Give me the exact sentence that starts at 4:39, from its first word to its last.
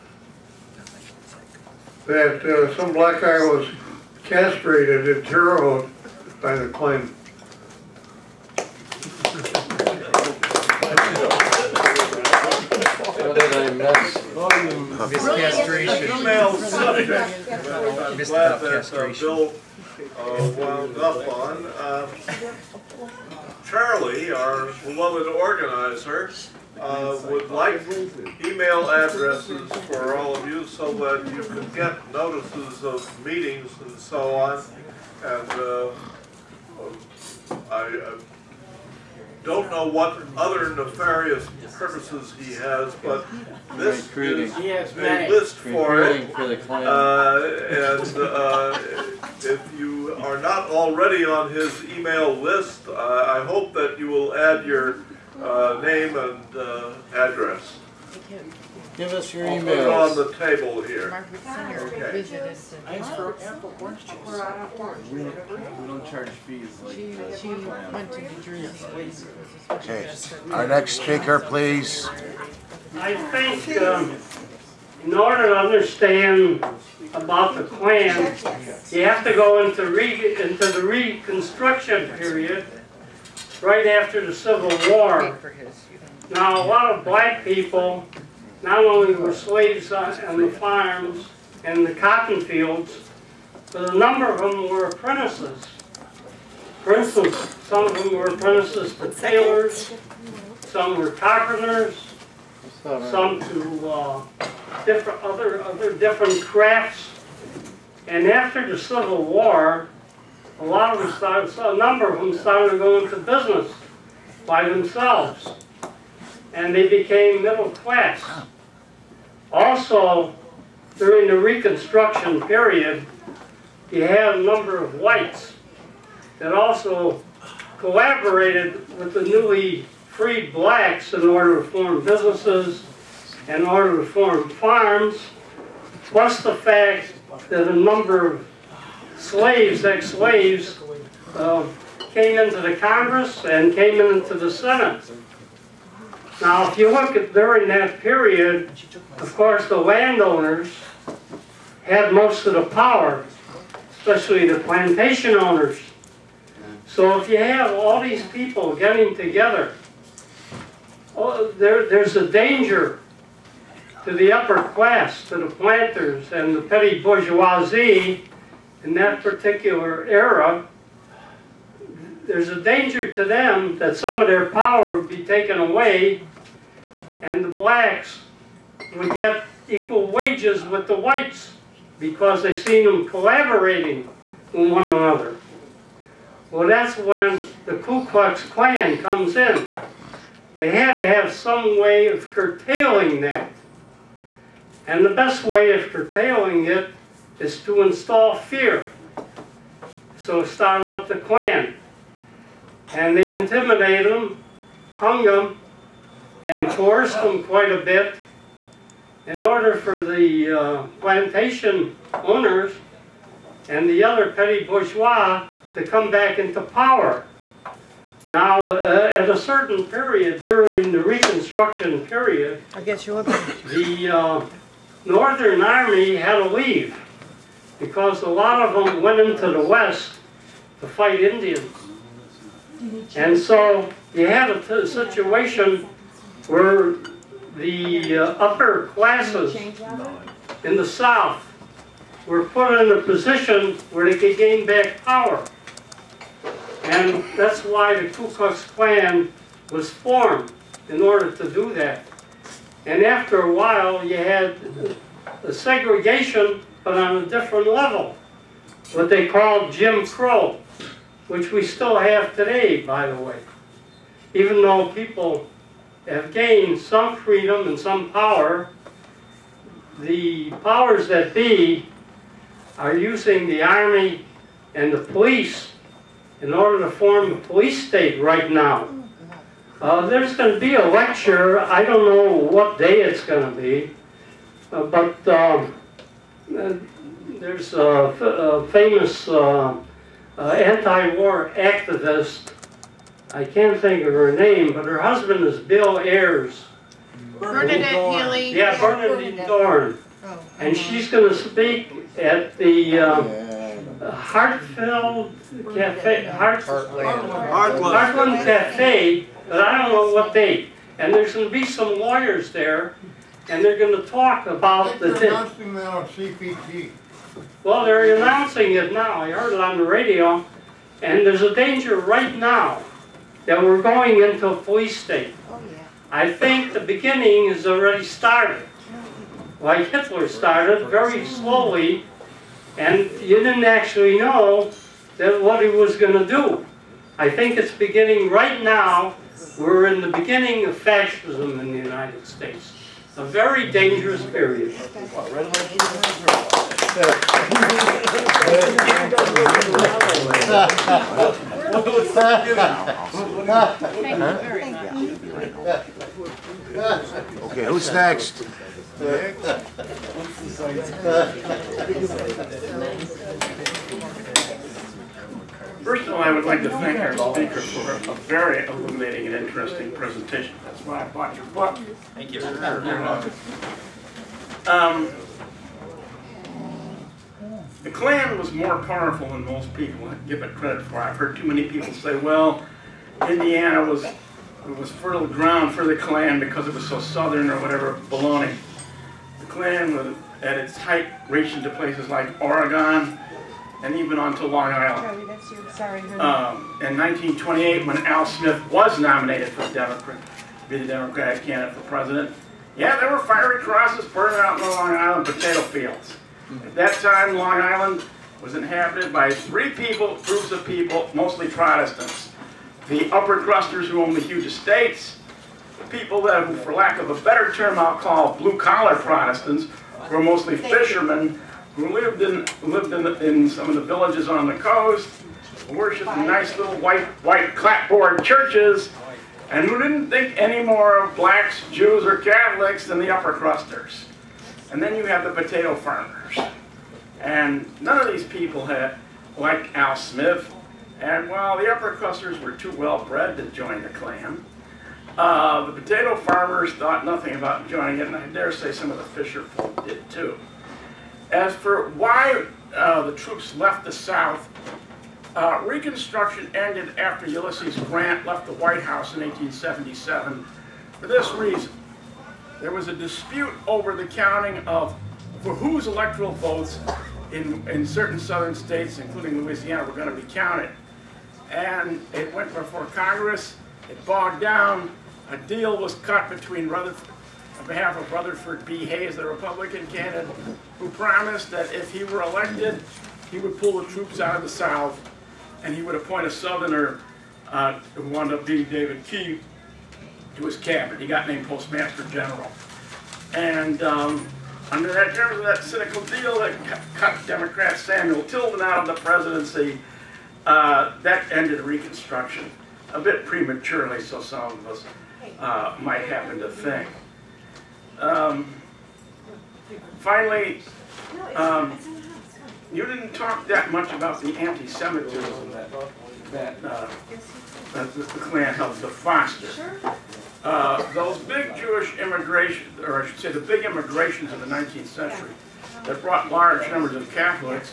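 Uh, there's going to be a lecture.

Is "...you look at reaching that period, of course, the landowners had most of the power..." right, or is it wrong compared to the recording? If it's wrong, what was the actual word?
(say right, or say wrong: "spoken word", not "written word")
wrong: "during", not "reaching".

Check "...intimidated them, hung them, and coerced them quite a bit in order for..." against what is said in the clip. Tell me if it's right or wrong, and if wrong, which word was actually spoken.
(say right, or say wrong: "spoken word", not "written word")
right.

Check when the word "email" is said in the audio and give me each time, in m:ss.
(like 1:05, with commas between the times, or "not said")
0:28, 0:51.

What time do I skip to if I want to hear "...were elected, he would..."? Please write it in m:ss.
8:02.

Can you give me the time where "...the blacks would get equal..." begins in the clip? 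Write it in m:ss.
2:57.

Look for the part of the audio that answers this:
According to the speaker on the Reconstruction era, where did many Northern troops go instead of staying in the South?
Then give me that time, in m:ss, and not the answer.
3:49.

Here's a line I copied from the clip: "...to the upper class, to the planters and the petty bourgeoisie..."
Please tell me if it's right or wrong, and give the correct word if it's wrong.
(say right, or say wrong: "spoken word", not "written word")
right.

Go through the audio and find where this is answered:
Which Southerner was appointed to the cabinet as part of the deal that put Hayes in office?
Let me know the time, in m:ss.
8:08.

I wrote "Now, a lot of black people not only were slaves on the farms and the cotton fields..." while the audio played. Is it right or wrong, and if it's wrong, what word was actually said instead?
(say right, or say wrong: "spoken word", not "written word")
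right.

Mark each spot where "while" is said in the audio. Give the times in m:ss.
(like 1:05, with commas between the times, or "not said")
4:13, 7:21.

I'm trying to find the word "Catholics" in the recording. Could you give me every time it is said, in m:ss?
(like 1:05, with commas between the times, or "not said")
7:12, 8:47.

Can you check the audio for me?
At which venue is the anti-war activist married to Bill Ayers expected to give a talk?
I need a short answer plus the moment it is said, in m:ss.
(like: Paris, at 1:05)
Heartland Cafe, at 5:07.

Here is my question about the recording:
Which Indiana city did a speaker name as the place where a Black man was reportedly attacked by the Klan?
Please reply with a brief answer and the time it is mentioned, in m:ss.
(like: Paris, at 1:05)
Terre Haute, at 0:05.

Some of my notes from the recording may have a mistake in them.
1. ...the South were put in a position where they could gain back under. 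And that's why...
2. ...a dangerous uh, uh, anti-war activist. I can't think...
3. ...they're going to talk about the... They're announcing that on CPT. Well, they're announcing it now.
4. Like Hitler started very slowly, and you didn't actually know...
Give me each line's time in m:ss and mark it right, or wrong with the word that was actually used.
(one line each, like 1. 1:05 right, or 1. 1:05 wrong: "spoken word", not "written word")
1. 4:00 wrong: "power", not "under"
2. 4:47 wrong: "famous", not "dangerous"
3. 5:13 right
4. 5:29 right.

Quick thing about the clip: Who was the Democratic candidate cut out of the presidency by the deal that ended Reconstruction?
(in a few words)
Samuel Tilden.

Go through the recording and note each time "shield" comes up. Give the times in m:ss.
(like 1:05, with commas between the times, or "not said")
not said.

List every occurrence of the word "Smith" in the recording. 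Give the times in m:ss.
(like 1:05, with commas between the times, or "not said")
6:38, 7:19.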